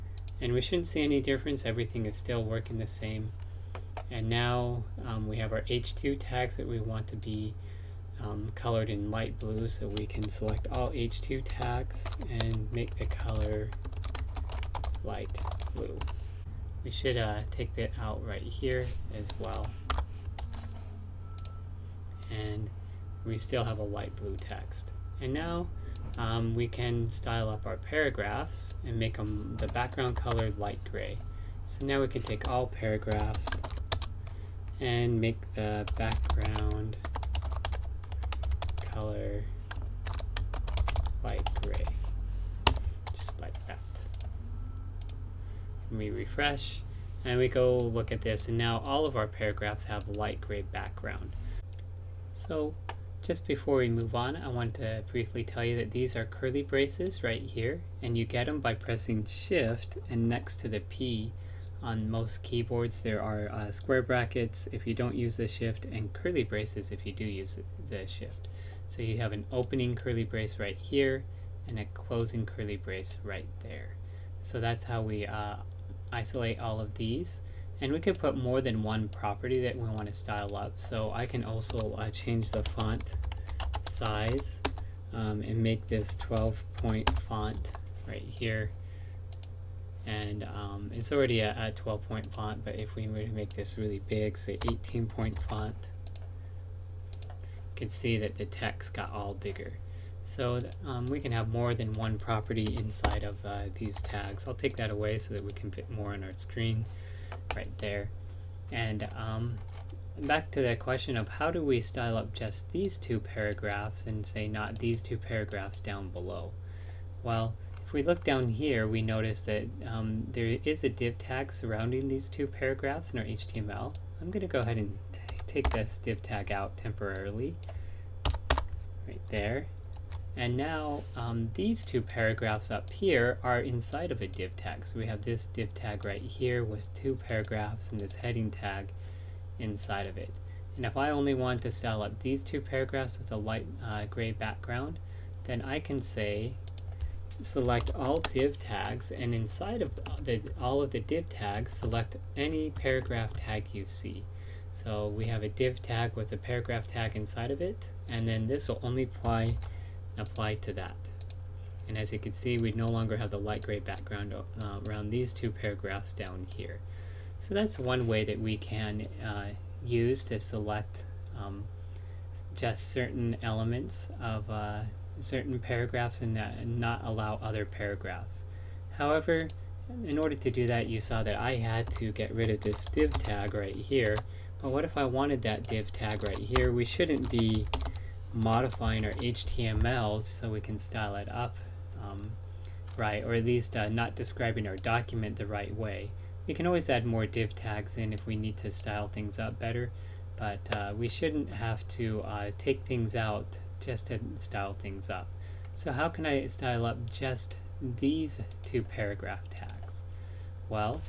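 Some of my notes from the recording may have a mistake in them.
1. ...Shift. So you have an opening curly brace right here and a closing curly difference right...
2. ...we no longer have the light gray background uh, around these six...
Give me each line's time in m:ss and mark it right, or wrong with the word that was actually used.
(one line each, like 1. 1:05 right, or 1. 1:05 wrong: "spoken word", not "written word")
1. 1:08 wrong: "brace", not "difference"
2. 2:42 wrong: "two", not "six".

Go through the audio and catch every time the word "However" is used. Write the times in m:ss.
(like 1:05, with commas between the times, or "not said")
2:58.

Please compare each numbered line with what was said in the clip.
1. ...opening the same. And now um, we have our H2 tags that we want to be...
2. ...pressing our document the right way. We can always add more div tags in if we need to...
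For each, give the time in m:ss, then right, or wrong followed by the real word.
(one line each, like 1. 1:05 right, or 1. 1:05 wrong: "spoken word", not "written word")
1. 0:02 wrong: "working", not "opening"
2. 3:14 wrong: "describing", not "pressing".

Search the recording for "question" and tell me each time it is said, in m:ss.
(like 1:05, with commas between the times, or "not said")
1:50.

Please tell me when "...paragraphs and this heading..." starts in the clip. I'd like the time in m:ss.
2:17.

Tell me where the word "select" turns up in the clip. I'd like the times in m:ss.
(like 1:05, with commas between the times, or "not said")
0:10, 2:27, 2:31, 2:50.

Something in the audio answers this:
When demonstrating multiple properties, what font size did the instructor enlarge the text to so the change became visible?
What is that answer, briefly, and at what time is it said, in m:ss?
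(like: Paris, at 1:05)
18 point, at 1:34.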